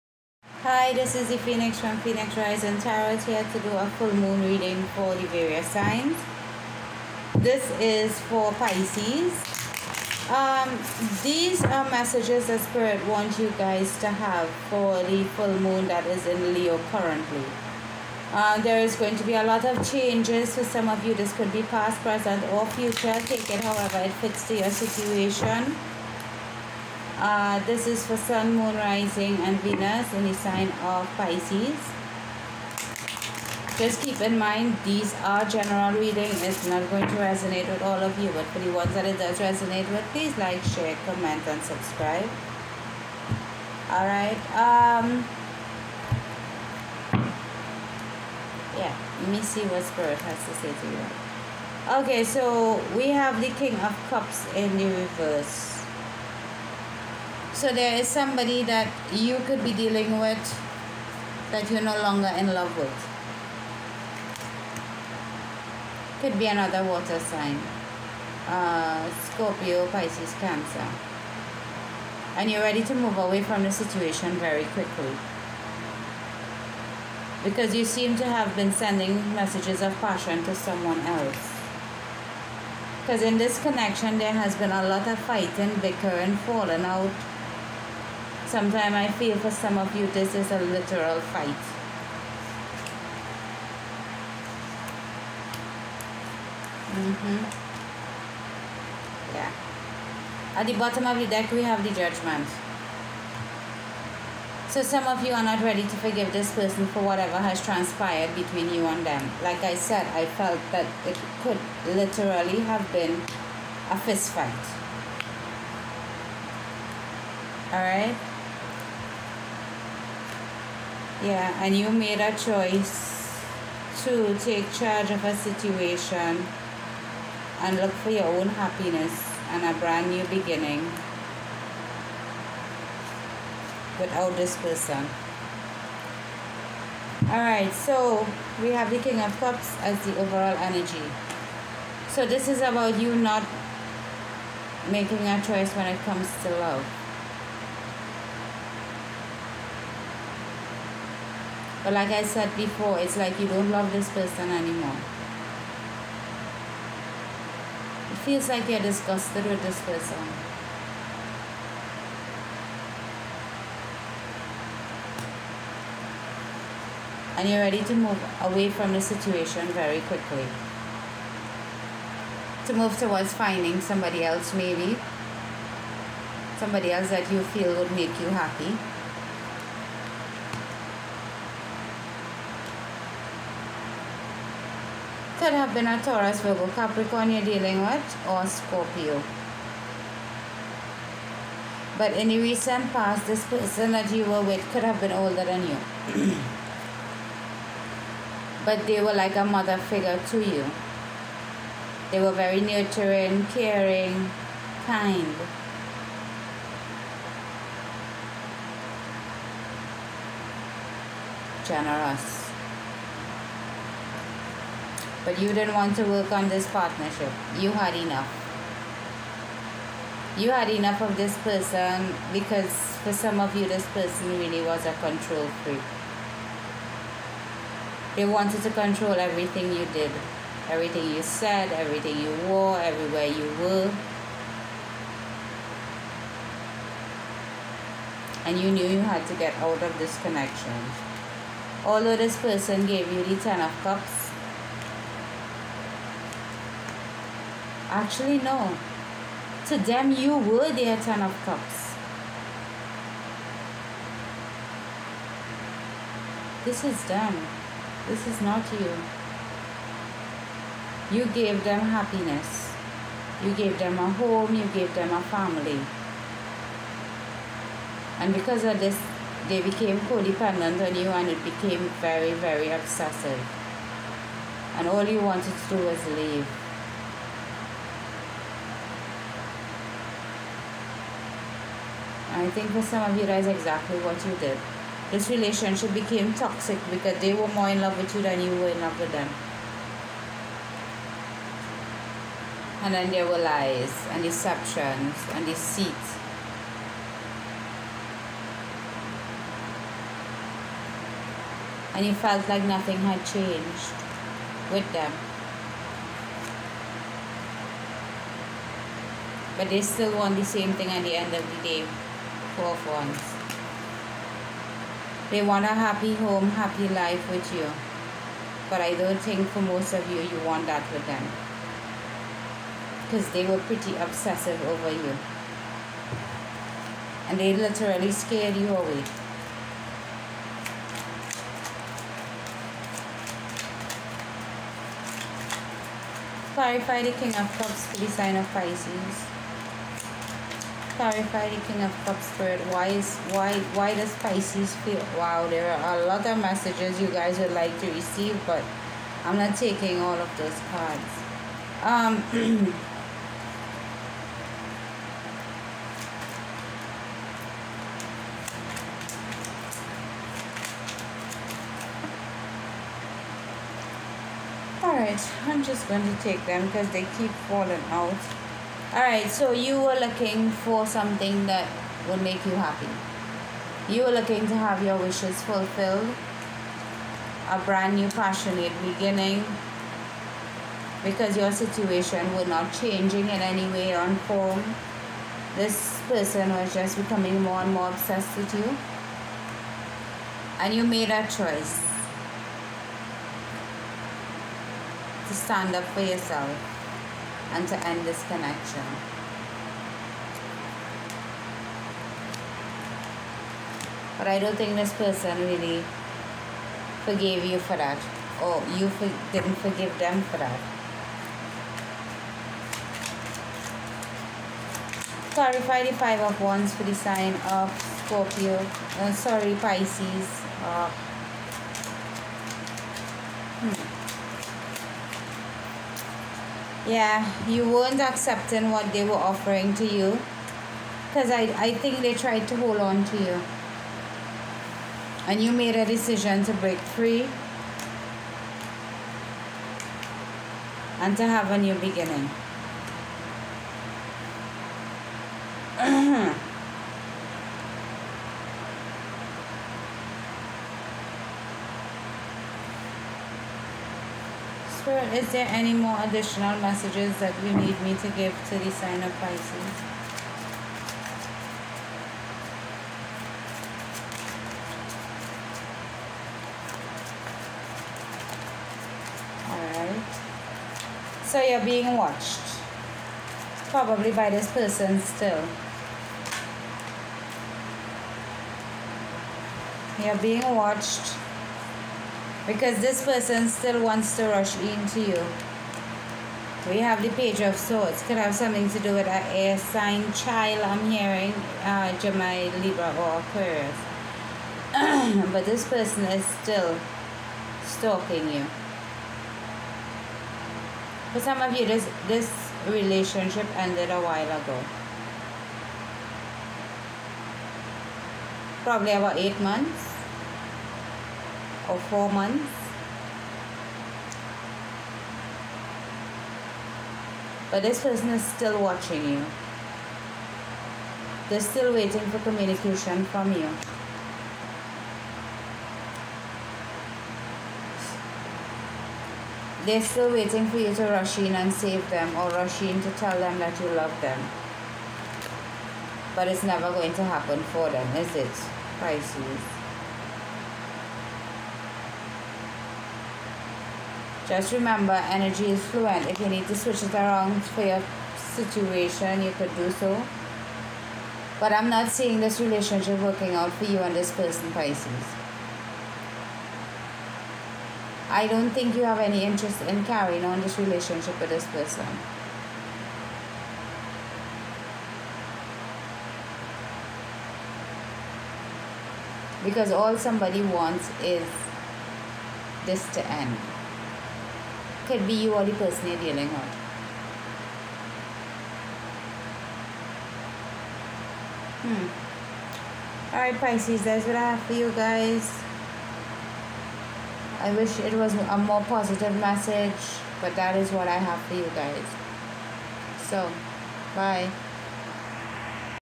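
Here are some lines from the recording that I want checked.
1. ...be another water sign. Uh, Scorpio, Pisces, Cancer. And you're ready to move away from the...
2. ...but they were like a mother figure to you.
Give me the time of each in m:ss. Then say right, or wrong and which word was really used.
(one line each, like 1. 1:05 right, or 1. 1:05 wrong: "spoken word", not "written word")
1. 1:06 right
2. 3:18 right.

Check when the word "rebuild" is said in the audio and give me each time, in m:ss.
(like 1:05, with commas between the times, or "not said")
not said.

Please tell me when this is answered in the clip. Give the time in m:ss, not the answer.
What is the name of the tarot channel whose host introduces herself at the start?
0:02.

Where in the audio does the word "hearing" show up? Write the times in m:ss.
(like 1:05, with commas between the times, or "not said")
8:10.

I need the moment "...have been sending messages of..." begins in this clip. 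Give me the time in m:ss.
1:18.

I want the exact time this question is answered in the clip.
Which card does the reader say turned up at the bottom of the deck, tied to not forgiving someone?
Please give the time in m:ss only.
1:41.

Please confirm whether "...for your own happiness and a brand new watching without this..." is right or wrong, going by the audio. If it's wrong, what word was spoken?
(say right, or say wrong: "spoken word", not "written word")
wrong: "beginning", not "watching".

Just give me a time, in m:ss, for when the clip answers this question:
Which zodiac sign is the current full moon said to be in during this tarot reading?
0:16.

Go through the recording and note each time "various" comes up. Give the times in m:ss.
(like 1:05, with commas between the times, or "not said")
0:05.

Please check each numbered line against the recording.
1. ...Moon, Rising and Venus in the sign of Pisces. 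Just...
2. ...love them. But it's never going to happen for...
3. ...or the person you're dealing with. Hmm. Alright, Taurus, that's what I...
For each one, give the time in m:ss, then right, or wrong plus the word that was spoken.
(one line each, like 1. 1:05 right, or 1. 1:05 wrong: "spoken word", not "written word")
1. 0:28 right
2. 8:53 right
3. 9:35 wrong: "Pisces", not "Taurus".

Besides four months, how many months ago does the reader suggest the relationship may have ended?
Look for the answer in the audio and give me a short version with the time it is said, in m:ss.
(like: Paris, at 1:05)
8, at 8:29.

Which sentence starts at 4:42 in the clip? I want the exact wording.
I think for some of you guys, exactly what you did.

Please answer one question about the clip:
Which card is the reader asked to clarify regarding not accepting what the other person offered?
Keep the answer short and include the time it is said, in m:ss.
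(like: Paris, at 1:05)
Five of Wands, at 6:55.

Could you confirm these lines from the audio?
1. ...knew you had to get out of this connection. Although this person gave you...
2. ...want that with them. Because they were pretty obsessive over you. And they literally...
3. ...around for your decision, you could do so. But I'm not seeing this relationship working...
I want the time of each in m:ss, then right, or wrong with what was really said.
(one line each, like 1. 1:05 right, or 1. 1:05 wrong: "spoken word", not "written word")
1. 3:58 right
2. 5:20 right
3. 9:06 wrong: "situation", not "decision".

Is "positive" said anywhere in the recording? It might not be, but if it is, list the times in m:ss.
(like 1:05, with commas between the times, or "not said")
9:48.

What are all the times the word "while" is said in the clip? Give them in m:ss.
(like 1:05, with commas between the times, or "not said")
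8:23.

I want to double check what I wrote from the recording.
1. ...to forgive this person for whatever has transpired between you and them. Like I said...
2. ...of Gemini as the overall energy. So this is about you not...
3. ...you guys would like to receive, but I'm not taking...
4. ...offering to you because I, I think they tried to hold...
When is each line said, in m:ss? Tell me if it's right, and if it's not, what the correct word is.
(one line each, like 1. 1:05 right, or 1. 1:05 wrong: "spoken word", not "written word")
1. 1:45 right
2. 2:19 wrong: "Cups", not "Gemini"
3. 5:47 right
4. 7:09 right.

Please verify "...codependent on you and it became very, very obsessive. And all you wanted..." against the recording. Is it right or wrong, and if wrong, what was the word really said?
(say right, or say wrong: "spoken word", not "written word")
right.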